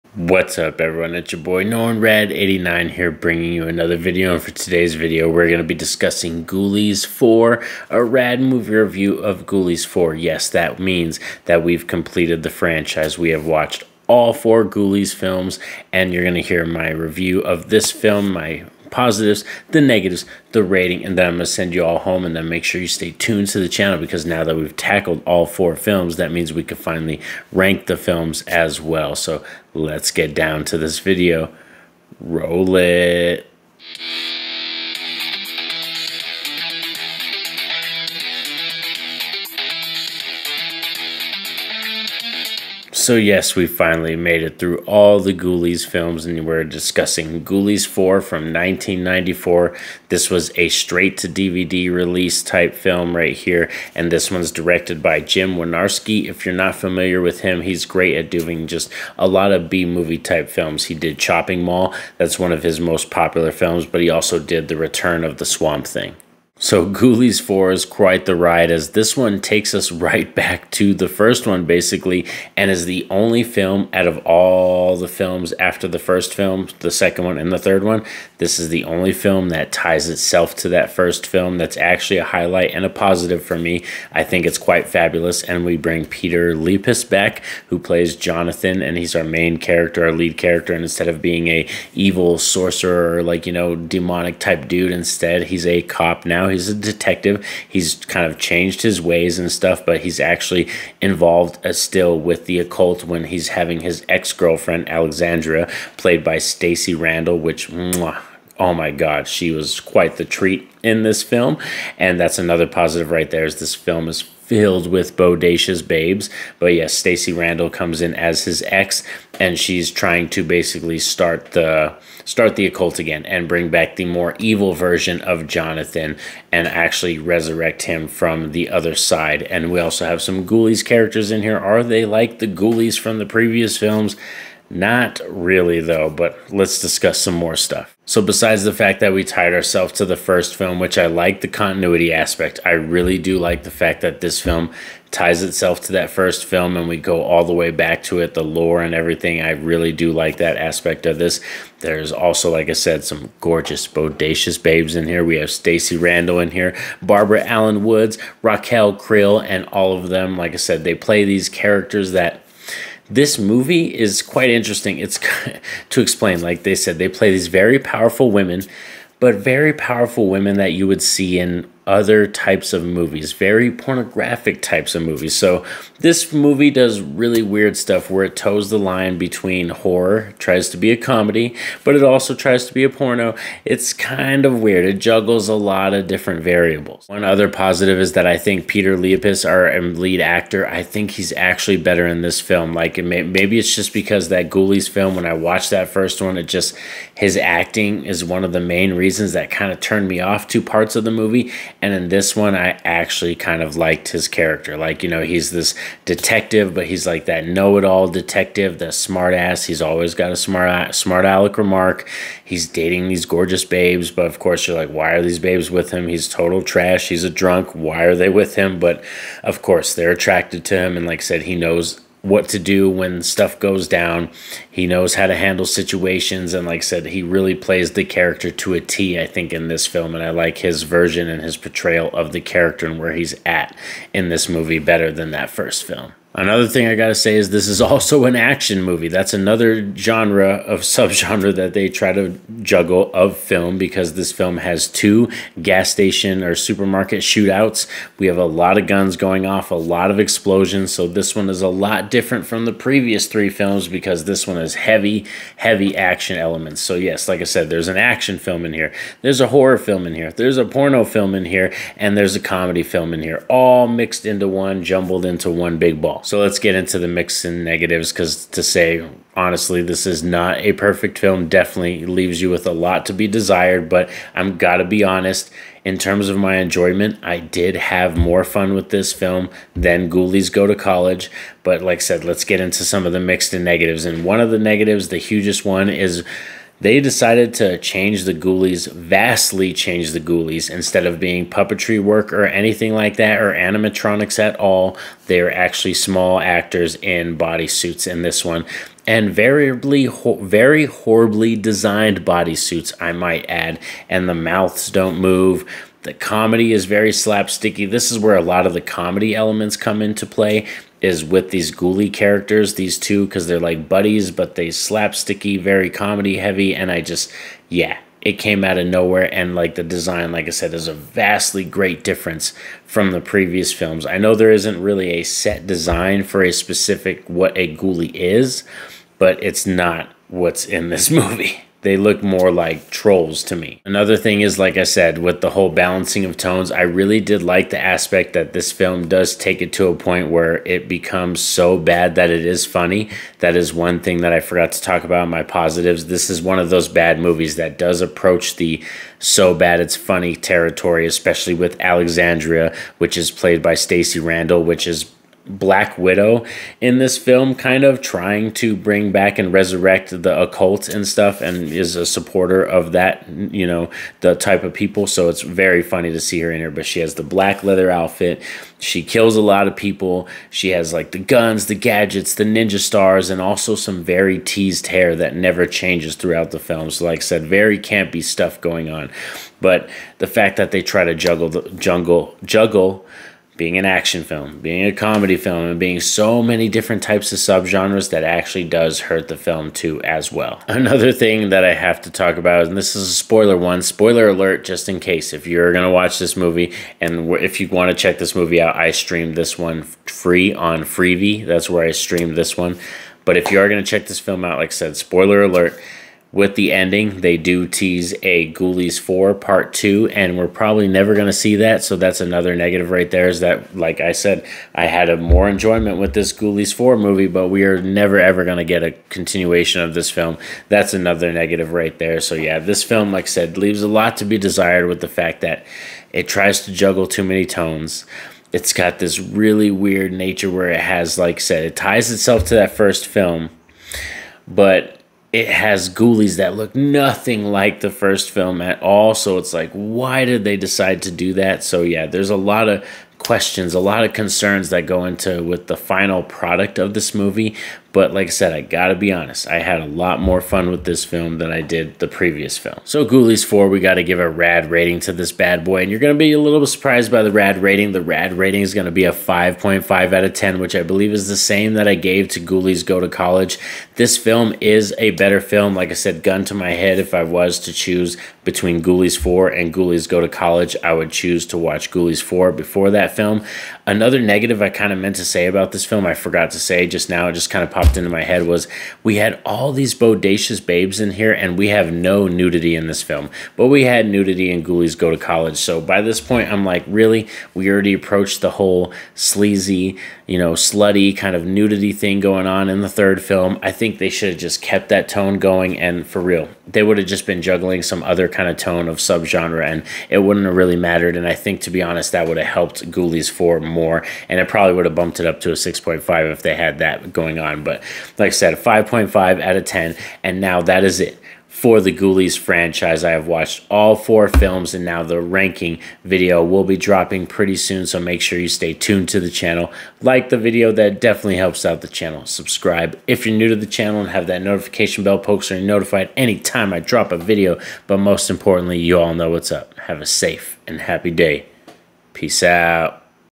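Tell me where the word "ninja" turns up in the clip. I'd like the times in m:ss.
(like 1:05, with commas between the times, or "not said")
6:12.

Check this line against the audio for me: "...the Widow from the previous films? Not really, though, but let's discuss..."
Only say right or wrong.
wrong.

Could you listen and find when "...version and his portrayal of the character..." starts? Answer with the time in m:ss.
3:50.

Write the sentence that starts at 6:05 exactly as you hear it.
So it's very funny to see her in here, but she has the black leather outfit.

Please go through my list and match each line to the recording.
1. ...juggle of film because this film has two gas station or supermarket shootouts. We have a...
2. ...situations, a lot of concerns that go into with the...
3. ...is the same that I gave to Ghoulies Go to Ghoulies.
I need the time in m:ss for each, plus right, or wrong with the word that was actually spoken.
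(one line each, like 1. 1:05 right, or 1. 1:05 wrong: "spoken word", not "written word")
1. 4:02 right
2. 7:23 wrong: "questions", not "situations"
3. 7:41 wrong: "College", not "Ghoulies".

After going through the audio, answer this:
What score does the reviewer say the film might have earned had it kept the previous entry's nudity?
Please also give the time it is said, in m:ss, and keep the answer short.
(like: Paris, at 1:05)
6.5, at 8:25.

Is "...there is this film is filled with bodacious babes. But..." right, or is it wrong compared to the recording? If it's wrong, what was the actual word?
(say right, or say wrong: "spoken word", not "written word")
right.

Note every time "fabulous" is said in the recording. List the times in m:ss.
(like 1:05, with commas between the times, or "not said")
1:24.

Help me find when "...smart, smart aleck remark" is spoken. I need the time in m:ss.
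3:30.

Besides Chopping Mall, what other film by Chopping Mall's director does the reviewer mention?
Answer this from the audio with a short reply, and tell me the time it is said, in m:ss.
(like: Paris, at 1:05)
The Return of the Swamp Thing, at 1:04.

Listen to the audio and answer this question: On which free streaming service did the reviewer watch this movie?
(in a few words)
Freevee.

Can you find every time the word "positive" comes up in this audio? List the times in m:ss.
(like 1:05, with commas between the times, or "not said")
0:18, 1:22, 1:52, 3:07, 5:45.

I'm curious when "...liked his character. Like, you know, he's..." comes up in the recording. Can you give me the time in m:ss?
3:23.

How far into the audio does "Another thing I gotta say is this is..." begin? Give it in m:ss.
3:56.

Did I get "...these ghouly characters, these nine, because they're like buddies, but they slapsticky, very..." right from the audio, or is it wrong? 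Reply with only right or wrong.
wrong.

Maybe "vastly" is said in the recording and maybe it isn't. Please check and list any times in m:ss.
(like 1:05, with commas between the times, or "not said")
4:48, 5:20.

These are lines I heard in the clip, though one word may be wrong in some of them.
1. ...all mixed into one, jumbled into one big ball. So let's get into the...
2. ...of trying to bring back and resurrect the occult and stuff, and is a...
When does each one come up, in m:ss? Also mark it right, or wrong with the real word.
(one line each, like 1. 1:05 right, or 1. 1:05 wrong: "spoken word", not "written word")
1. 4:23 right
2. 5:57 right.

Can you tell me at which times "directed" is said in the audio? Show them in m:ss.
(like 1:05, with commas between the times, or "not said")
0:54.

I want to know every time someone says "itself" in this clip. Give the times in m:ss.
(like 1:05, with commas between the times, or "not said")
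1:20, 2:25, 7:12.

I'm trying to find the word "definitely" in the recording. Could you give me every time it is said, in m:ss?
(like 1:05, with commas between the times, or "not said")
4:31, 8:41.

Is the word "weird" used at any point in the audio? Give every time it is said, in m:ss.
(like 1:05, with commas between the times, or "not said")
2:57, 3:04, 7:09.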